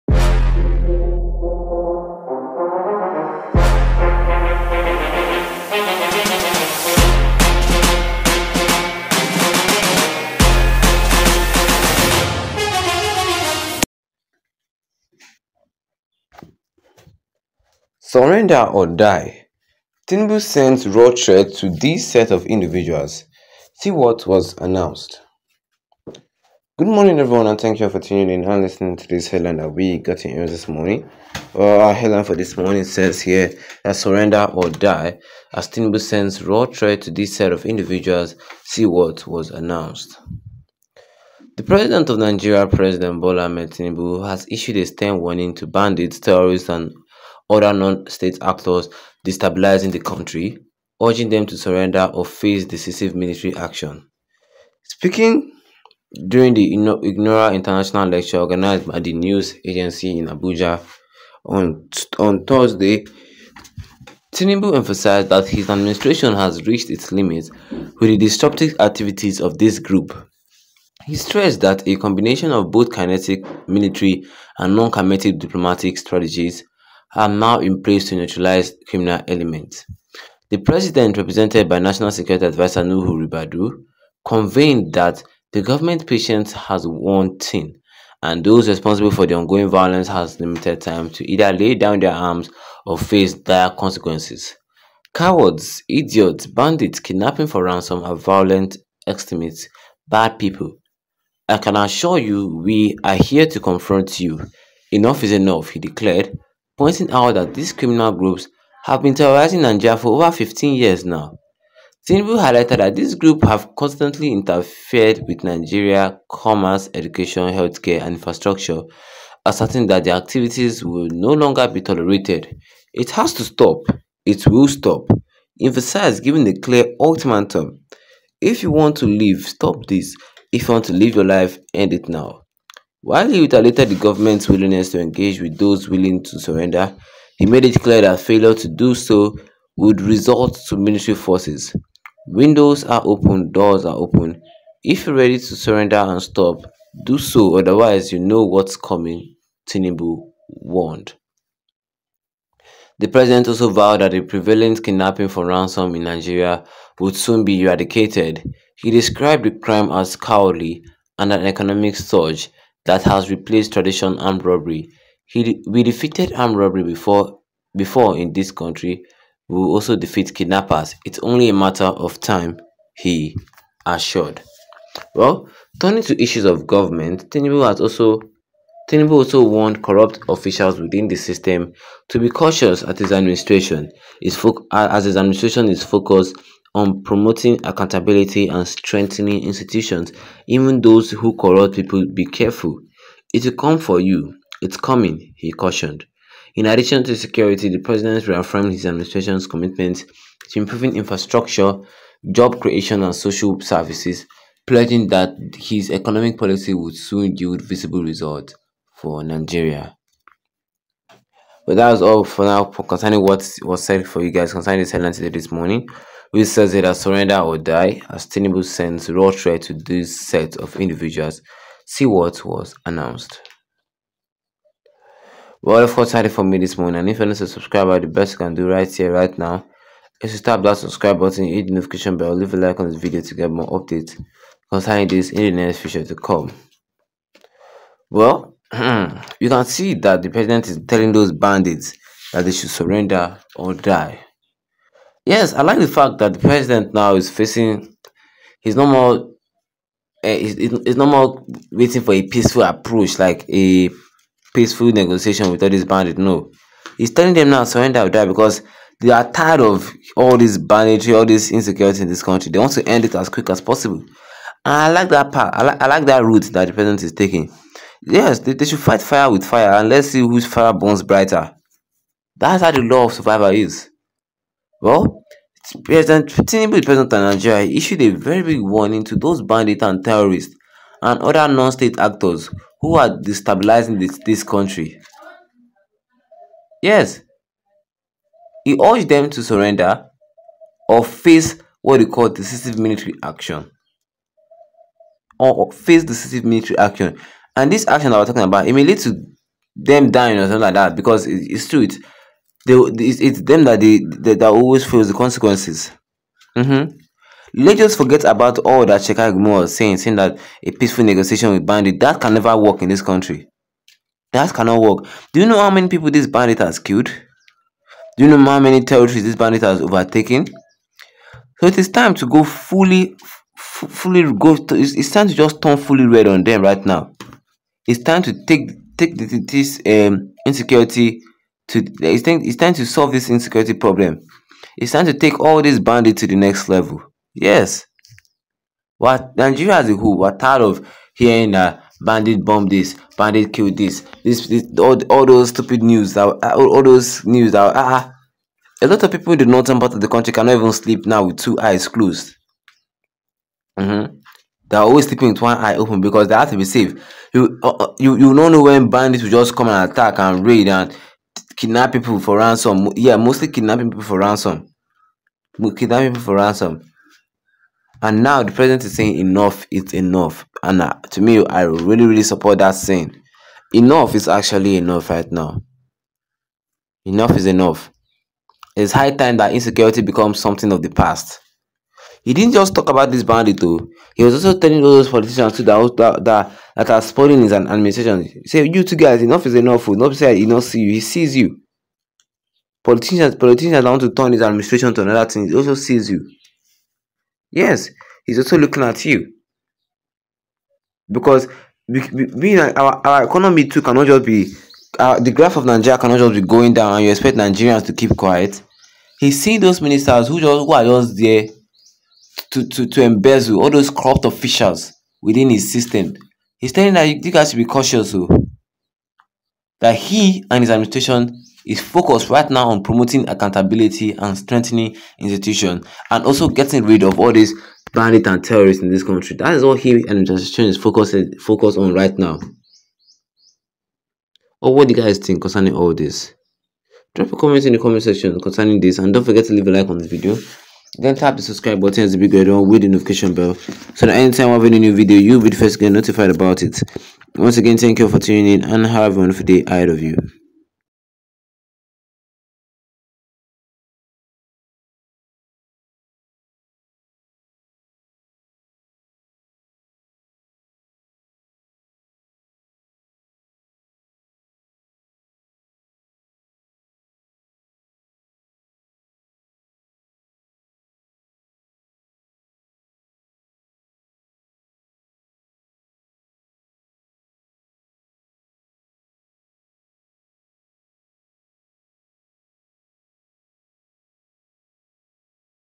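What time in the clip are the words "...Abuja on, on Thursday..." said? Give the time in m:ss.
1:00.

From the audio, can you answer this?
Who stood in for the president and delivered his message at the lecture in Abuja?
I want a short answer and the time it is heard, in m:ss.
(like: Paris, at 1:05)
Nuhu Ribadu, at 1:22.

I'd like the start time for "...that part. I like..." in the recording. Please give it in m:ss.
4:25.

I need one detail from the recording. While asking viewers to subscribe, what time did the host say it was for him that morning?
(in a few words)
4:30.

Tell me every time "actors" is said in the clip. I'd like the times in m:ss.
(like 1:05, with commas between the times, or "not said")
0:48, 4:41.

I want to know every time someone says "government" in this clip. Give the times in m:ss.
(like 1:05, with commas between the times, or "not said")
1:25, 2:13, 2:56.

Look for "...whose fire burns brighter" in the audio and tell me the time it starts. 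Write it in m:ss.
4:30.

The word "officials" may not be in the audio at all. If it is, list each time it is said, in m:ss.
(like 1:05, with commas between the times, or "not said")
3:00, 6:54.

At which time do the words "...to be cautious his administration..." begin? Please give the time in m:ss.
3:02.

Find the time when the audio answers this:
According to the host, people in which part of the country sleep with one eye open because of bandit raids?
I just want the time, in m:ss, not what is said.
5:49.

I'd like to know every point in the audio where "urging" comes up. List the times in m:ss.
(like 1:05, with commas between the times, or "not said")
0:51.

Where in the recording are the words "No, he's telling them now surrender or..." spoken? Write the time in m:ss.
4:16.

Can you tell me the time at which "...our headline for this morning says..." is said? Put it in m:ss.
0:31.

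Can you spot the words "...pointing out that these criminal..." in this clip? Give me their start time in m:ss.
1:46.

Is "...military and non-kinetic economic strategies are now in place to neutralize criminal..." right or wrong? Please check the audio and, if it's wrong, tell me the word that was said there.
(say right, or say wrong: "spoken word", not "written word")
wrong: "diplomatic", not "economic".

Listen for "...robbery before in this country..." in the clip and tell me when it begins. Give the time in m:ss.
2:46.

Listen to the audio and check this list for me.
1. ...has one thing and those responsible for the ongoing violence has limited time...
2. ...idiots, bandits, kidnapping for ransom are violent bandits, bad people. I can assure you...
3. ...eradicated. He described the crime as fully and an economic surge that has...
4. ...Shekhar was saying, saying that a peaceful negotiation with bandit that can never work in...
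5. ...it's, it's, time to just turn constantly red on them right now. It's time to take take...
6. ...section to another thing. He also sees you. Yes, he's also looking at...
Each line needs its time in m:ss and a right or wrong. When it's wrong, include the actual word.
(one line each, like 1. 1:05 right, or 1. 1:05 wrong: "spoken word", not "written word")
1. 1:26 right
2. 1:35 wrong: "extremists", not "bandits"
3. 2:37 wrong: "cowardly", not "fully"
4. 5:09 right
5. 5:24 wrong: "fully", not "constantly"
6. 6:34 wrong: "administration", not "section".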